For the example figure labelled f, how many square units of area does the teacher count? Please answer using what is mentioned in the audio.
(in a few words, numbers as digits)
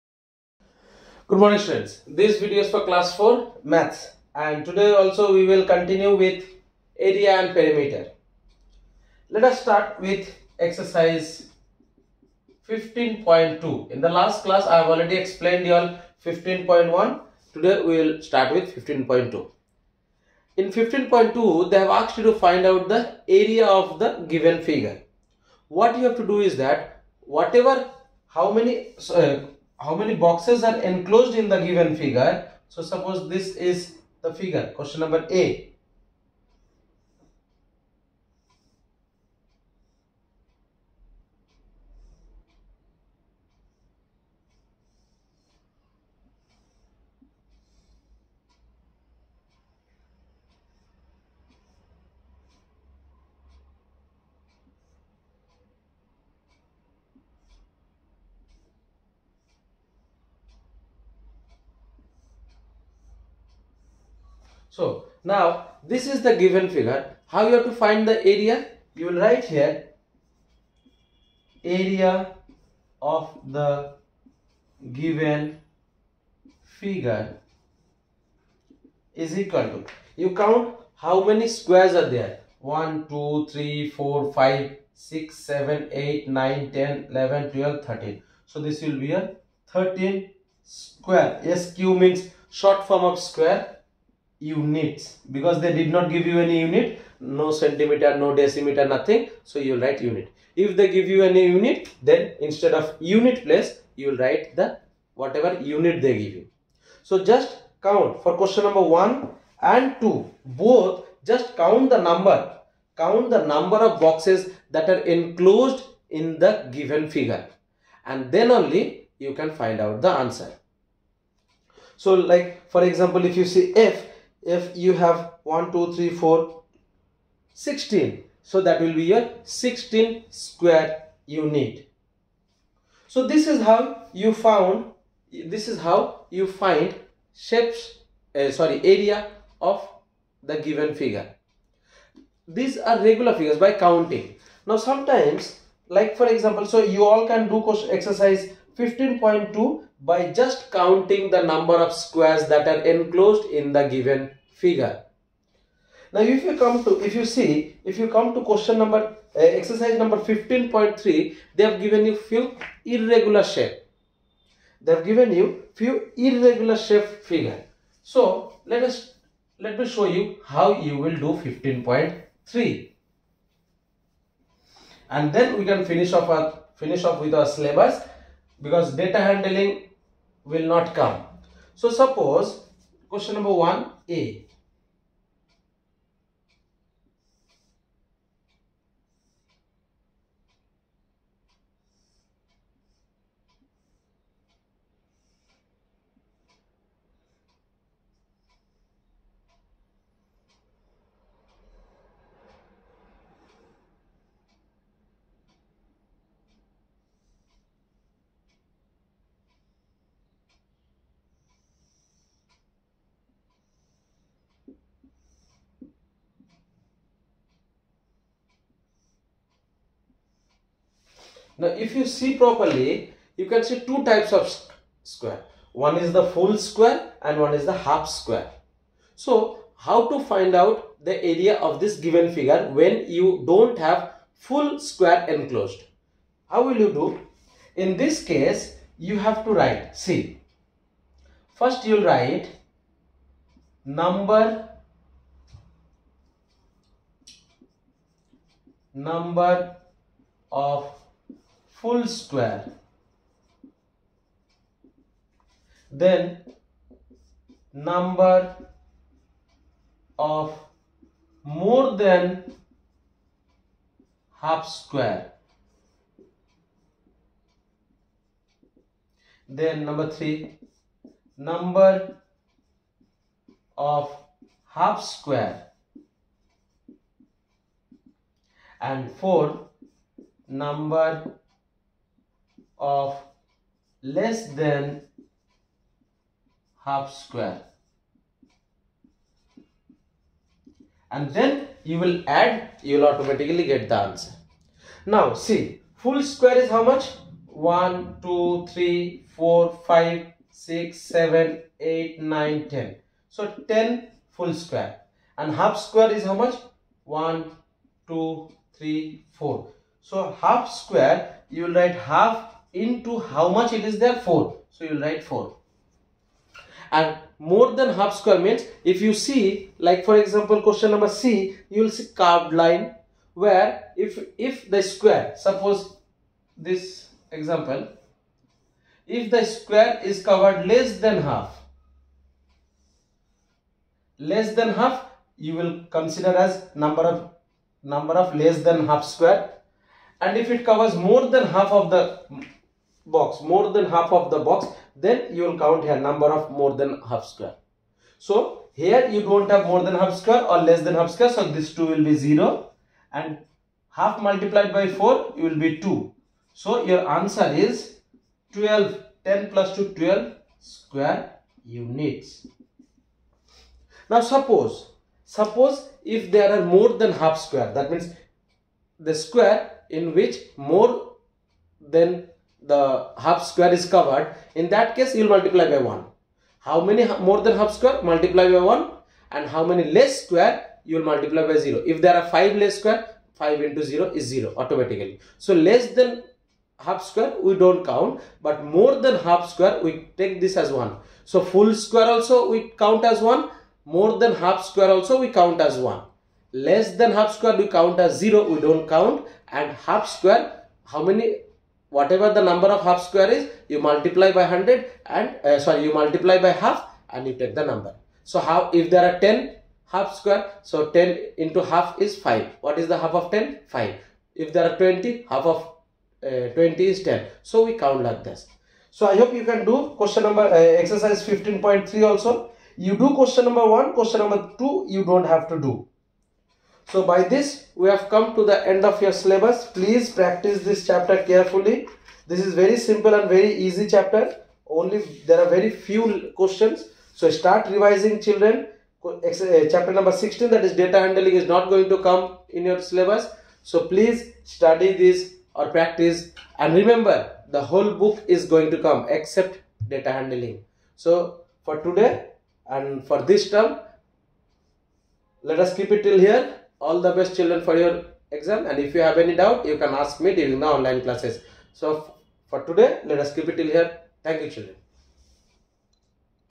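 16.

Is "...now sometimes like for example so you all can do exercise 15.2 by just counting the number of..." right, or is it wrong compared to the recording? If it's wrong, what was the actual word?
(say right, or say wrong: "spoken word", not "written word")
right.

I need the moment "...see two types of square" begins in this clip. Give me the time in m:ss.
3:43.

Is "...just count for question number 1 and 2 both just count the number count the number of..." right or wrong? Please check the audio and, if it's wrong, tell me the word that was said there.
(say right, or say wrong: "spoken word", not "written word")
right.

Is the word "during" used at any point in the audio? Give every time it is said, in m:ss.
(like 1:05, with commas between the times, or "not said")
7:40.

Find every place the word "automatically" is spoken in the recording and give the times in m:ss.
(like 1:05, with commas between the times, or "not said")
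4:53, 6:24.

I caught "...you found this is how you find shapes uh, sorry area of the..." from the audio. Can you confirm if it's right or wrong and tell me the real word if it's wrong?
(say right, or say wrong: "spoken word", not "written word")
right.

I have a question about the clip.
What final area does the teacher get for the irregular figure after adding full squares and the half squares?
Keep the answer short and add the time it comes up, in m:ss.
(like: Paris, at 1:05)
12 square units, at 5:59.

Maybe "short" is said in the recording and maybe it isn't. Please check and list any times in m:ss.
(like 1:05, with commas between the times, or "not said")
1:32.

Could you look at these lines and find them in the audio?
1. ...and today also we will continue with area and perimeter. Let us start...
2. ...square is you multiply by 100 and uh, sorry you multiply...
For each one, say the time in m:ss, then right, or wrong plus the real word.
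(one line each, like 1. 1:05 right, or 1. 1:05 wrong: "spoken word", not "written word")
1. 0:04 right
2. 6:43 right.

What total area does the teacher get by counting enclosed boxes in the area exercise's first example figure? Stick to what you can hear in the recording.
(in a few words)
13 square units.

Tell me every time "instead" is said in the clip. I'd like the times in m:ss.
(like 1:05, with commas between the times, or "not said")
1:42.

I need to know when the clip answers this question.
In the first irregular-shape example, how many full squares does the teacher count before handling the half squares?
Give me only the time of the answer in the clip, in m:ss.
5:03.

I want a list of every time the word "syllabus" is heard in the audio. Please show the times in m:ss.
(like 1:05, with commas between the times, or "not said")
2:57, 7:09, 7:22.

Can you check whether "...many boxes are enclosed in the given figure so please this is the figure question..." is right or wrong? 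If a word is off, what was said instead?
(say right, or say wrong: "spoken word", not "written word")
wrong: "suppose", not "please".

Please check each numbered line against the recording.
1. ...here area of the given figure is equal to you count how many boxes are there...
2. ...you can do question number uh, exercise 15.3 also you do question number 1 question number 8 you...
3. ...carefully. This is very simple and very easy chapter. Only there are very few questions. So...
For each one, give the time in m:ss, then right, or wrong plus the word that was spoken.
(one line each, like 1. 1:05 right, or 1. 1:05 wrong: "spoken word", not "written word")
1. 1:09 wrong: "squares", not "boxes"
2. 6:59 wrong: "2", not "8"
3. 7:11 right.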